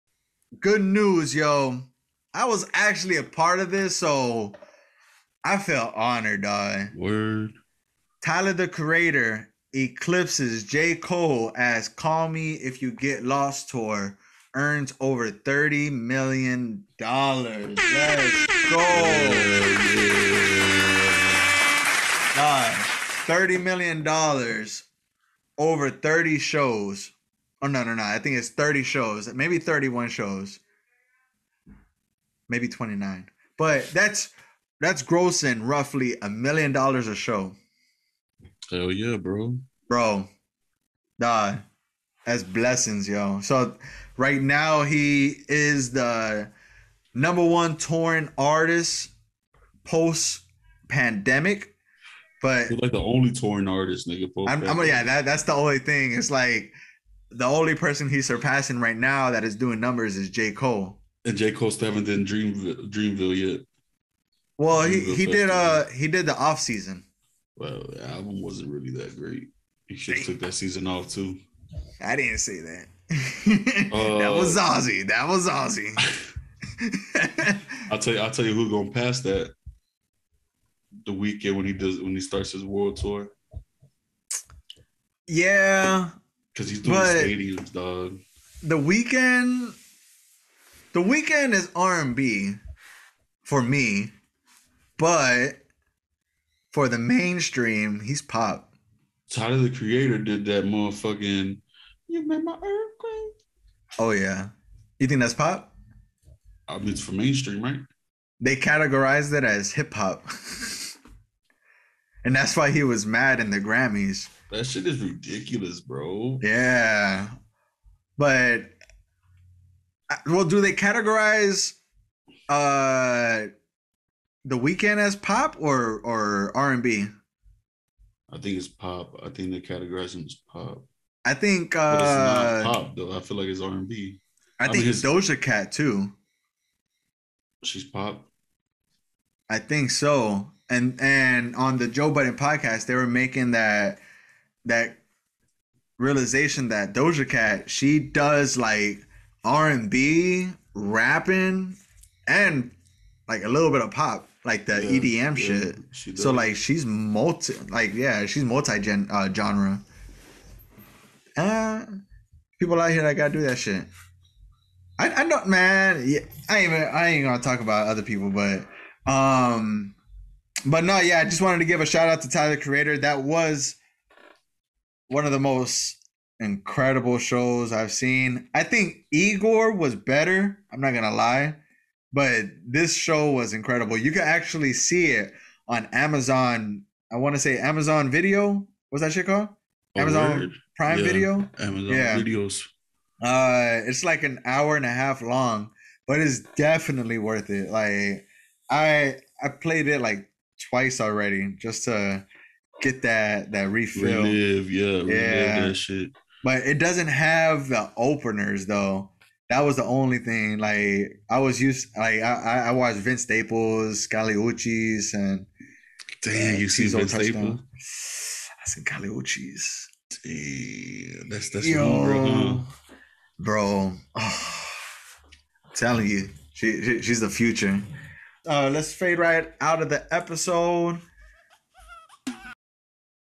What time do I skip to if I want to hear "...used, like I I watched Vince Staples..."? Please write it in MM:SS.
03:31.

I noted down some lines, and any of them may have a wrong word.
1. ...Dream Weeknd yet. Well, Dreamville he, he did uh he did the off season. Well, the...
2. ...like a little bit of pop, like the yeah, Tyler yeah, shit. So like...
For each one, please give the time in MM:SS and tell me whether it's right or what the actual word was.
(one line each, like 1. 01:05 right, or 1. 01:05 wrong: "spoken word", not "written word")
1. 01:02 wrong: "Dreamville", not "Weeknd"
2. 02:33 wrong: "EDM", not "Tyler".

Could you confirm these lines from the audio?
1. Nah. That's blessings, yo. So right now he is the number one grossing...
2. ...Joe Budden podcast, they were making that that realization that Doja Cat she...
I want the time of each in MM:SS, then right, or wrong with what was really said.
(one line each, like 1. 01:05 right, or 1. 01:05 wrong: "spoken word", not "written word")
1. 00:41 wrong: "touring", not "grossing"
2. 02:21 right.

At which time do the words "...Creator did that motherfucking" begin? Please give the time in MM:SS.
01:39.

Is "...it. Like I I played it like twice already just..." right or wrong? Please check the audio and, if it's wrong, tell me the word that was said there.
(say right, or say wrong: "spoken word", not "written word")
right.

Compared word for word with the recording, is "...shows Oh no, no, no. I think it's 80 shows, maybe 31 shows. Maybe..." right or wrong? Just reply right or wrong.
wrong.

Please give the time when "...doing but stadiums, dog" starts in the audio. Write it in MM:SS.
01:26.